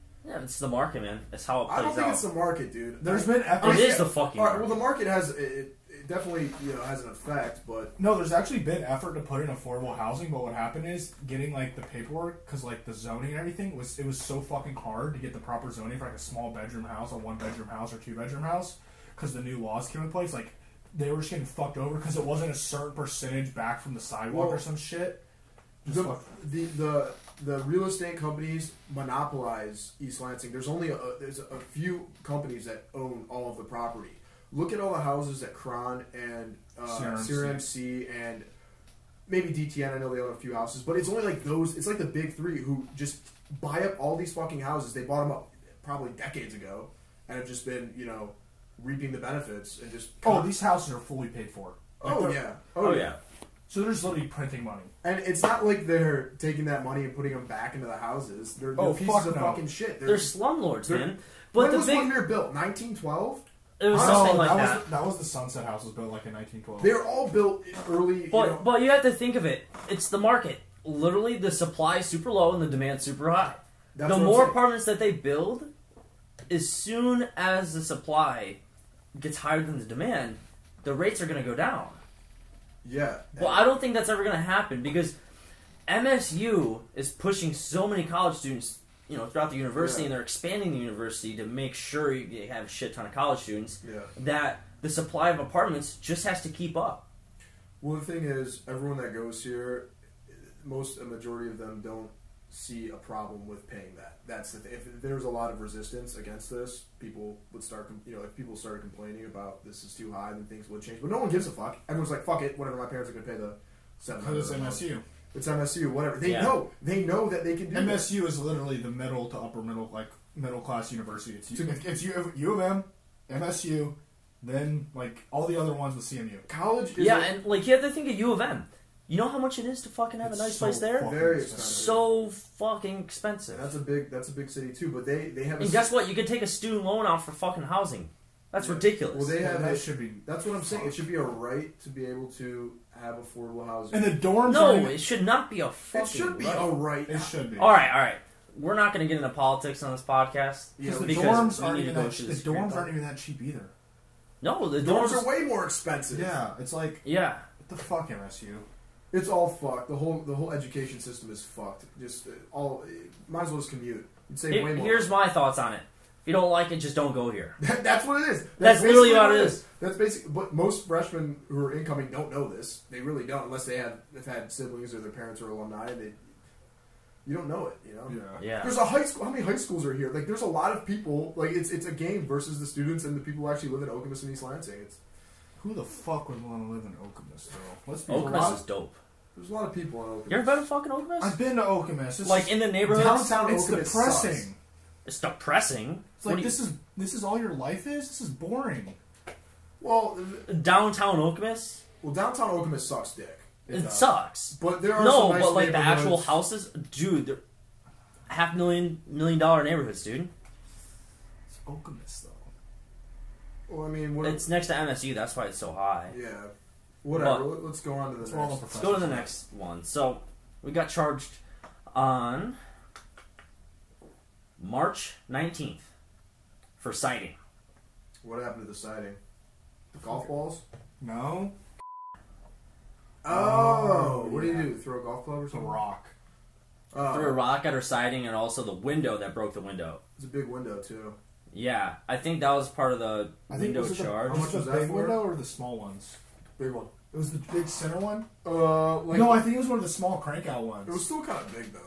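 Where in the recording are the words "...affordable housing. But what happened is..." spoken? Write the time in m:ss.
0:09.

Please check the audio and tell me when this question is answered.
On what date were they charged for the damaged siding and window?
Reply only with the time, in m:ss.
3:44.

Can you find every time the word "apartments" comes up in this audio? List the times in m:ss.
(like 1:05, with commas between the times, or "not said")
1:14, 1:35.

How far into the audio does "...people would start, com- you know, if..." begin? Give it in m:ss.
1:46.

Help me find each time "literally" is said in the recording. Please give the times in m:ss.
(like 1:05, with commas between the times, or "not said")
0:54, 1:10, 1:58, 2:48.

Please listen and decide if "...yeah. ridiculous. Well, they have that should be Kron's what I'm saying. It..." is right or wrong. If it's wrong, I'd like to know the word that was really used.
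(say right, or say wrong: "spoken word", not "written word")
wrong: "That", not "Kron".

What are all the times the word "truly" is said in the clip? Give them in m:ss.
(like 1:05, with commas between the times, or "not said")
not said.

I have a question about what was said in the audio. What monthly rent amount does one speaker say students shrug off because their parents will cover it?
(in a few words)
700.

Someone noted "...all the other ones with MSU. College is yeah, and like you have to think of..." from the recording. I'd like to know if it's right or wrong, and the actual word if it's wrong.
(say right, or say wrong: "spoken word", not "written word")
wrong: "CMU", not "MSU".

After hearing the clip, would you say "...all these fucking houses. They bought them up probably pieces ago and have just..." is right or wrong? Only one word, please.
wrong.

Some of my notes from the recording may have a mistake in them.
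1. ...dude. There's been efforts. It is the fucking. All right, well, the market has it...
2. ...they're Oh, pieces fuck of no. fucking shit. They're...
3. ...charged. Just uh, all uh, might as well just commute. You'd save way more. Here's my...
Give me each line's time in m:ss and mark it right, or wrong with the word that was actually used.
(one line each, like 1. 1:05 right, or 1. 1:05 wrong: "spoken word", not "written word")
1. 0:02 right
2. 0:58 right
3. 2:41 wrong: "fucked", not "charged".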